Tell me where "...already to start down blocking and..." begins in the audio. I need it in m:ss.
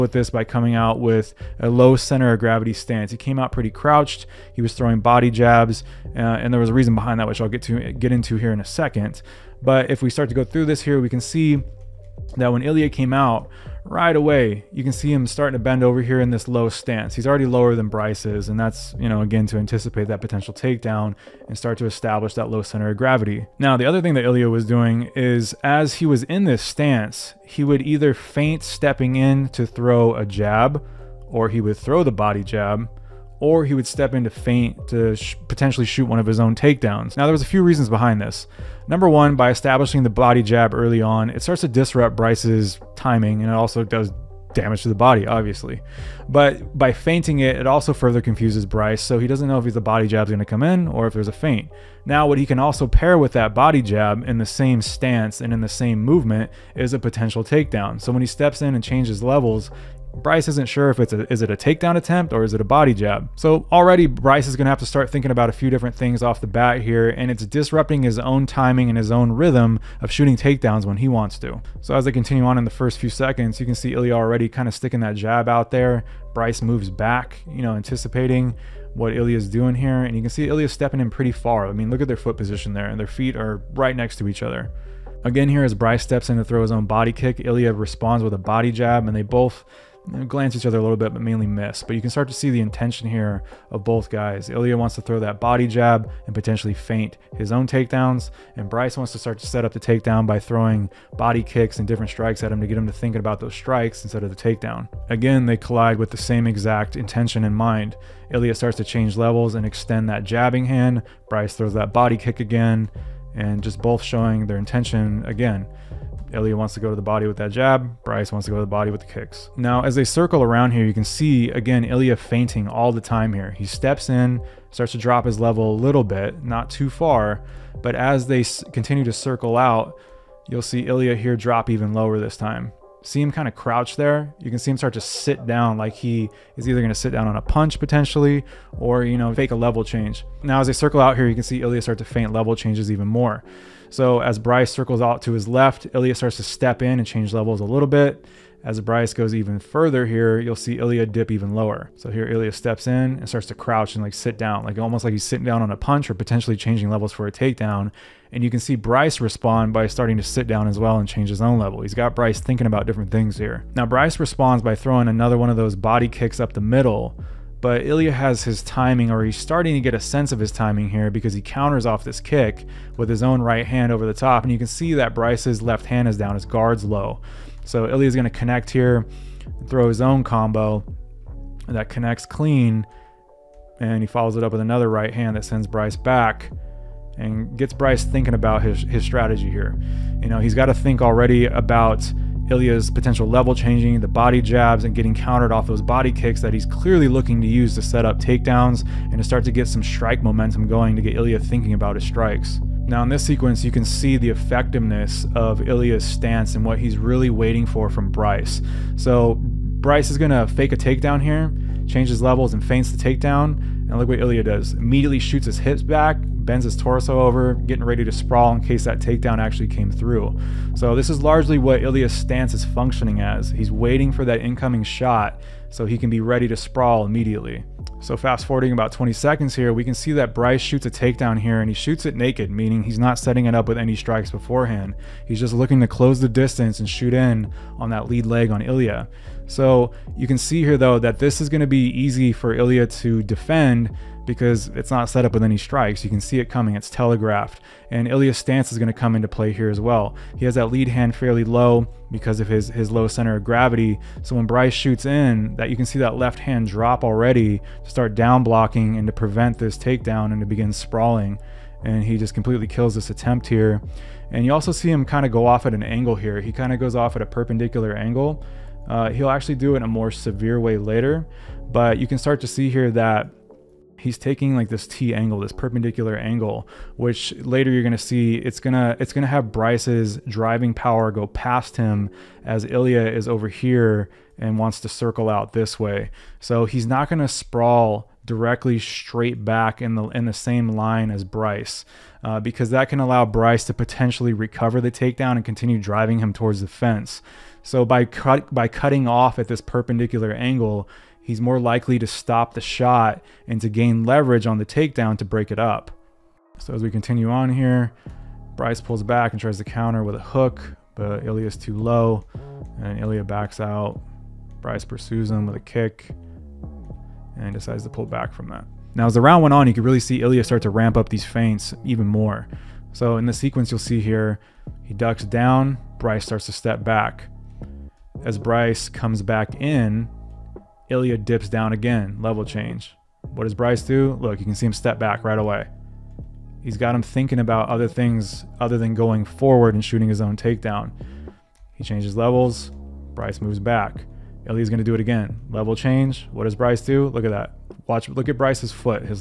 4:17.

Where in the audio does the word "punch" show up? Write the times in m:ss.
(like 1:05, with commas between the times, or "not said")
2:17, 2:35.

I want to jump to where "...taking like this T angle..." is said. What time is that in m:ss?
4:34.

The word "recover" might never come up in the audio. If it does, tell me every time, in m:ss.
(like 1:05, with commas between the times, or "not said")
4:54.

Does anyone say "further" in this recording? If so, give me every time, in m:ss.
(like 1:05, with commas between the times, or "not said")
0:47, 2:29.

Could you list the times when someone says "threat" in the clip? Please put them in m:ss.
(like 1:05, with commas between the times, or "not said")
not said.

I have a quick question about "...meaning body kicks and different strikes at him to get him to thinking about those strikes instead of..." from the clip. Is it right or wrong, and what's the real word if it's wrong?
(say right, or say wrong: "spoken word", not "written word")
wrong: "throwing", not "meaning".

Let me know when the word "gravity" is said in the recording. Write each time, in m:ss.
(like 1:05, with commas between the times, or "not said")
0:02, 0:22, 4:13.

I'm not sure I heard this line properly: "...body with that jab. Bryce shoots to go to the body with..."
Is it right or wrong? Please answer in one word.
wrong.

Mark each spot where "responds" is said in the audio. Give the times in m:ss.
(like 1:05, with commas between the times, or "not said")
1:27, 2:39, 2:44.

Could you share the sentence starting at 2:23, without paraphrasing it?
So as Bryce circles out to his left, Ilya starts to step in and change levels a little bit.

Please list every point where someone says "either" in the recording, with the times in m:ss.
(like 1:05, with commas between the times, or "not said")
0:27, 2:16.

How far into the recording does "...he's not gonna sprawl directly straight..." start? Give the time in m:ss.
4:46.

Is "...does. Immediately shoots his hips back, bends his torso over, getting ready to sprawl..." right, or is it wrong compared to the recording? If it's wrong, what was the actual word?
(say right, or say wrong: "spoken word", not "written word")
right.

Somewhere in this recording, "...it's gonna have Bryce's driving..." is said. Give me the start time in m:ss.
4:38.